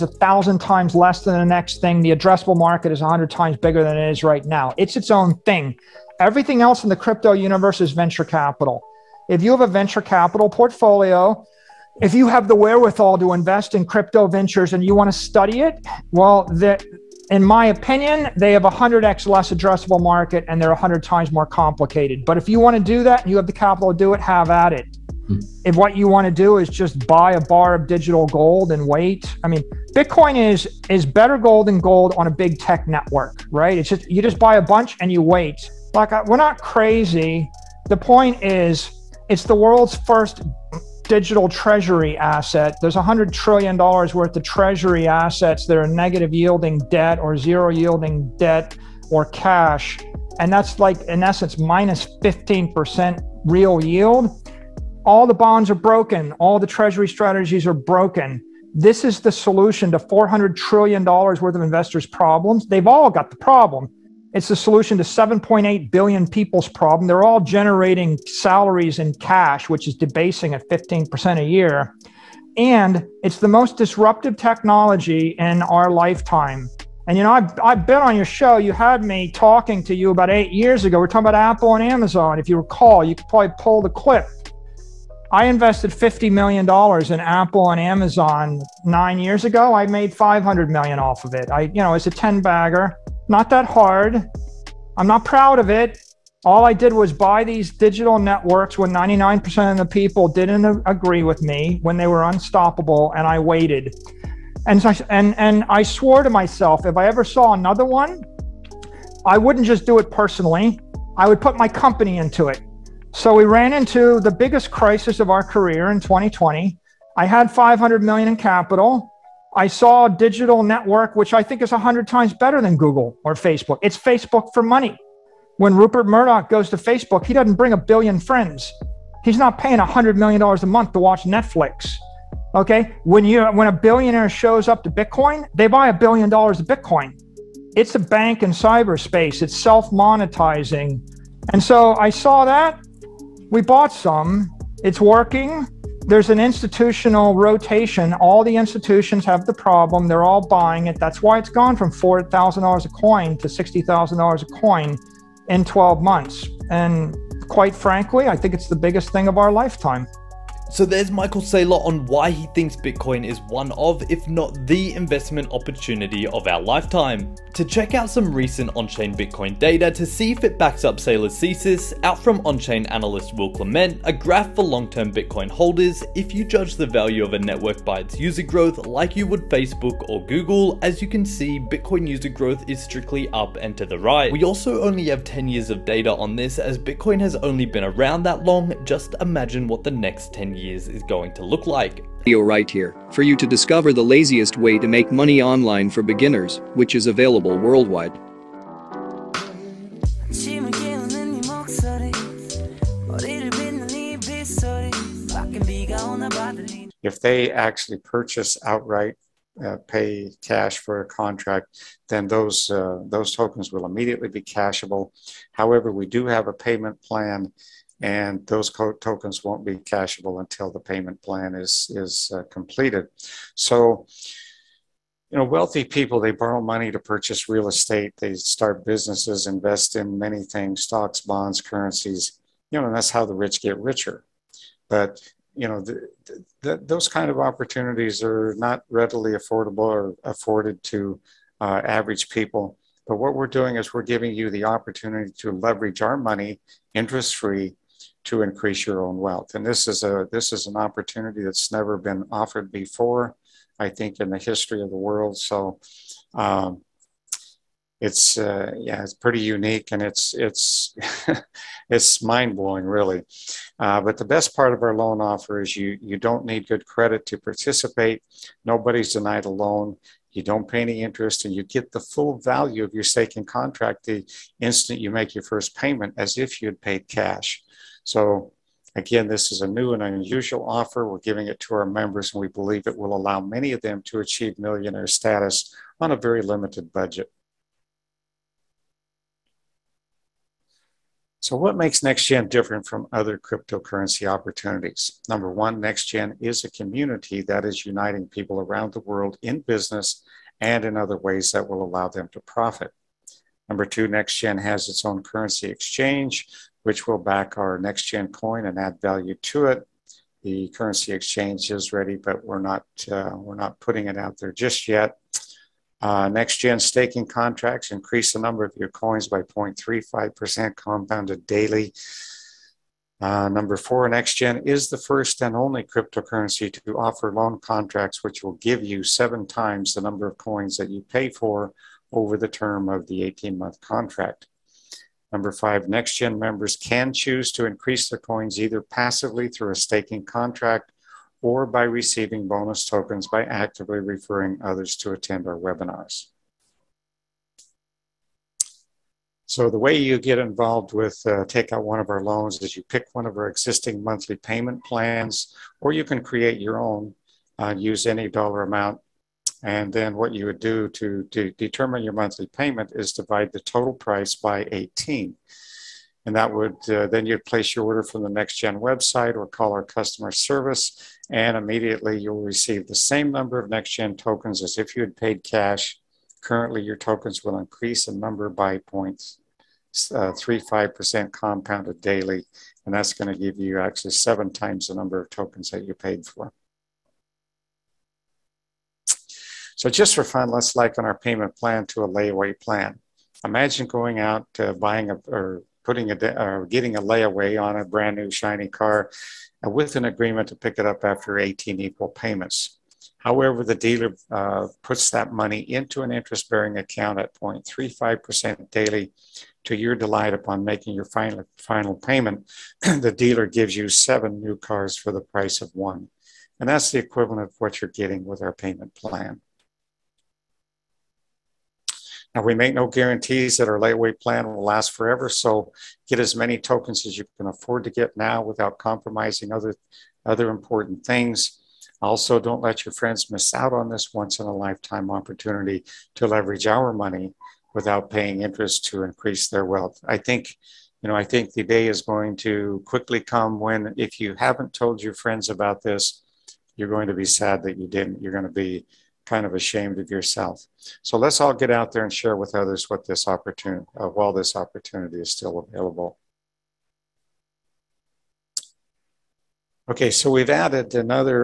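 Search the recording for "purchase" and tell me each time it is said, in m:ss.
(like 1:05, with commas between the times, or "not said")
3:27, 3:46.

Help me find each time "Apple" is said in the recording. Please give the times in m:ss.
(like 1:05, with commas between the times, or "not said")
1:21, 1:27.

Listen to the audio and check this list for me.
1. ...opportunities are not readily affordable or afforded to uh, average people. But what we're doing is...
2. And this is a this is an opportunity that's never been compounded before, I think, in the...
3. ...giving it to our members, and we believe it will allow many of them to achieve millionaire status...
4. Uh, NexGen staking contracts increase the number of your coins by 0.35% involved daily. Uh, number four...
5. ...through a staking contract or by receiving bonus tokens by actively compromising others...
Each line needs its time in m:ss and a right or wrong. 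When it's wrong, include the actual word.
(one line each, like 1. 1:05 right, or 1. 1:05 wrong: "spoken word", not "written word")
1. 3:57 right
2. 4:09 wrong: "offered", not "compounded"
3. 4:41 right
4. 5:15 wrong: "compounded", not "involved"
5. 5:39 wrong: "referring", not "compromising".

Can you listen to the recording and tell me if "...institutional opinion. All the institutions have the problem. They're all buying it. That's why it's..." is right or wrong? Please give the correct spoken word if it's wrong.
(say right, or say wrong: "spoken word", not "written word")
wrong: "rotation", not "opinion".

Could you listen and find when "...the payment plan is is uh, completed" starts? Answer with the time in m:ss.
3:40.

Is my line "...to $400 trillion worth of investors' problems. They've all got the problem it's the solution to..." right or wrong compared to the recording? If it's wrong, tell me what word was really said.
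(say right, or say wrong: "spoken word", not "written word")
right.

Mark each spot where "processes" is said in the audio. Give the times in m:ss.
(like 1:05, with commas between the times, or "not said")
not said.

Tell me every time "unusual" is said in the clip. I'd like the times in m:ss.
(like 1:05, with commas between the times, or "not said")
4:40.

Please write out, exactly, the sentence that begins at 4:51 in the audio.
So, what makes NexGen different from other cryptocurrency opportunities?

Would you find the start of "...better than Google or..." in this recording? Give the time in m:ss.
2:02.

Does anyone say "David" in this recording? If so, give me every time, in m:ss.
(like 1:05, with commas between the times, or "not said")
not said.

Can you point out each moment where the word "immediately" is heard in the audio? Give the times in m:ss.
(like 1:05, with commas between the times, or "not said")
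3:33, 6:11.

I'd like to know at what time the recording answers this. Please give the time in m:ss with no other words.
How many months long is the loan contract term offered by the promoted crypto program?
5:33.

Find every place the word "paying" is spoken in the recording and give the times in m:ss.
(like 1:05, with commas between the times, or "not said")
2:09, 7:18.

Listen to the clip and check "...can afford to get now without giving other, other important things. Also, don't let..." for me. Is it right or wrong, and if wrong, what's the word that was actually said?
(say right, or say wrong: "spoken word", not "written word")
wrong: "compromising", not "giving".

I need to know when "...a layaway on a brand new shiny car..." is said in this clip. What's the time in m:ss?
6:36.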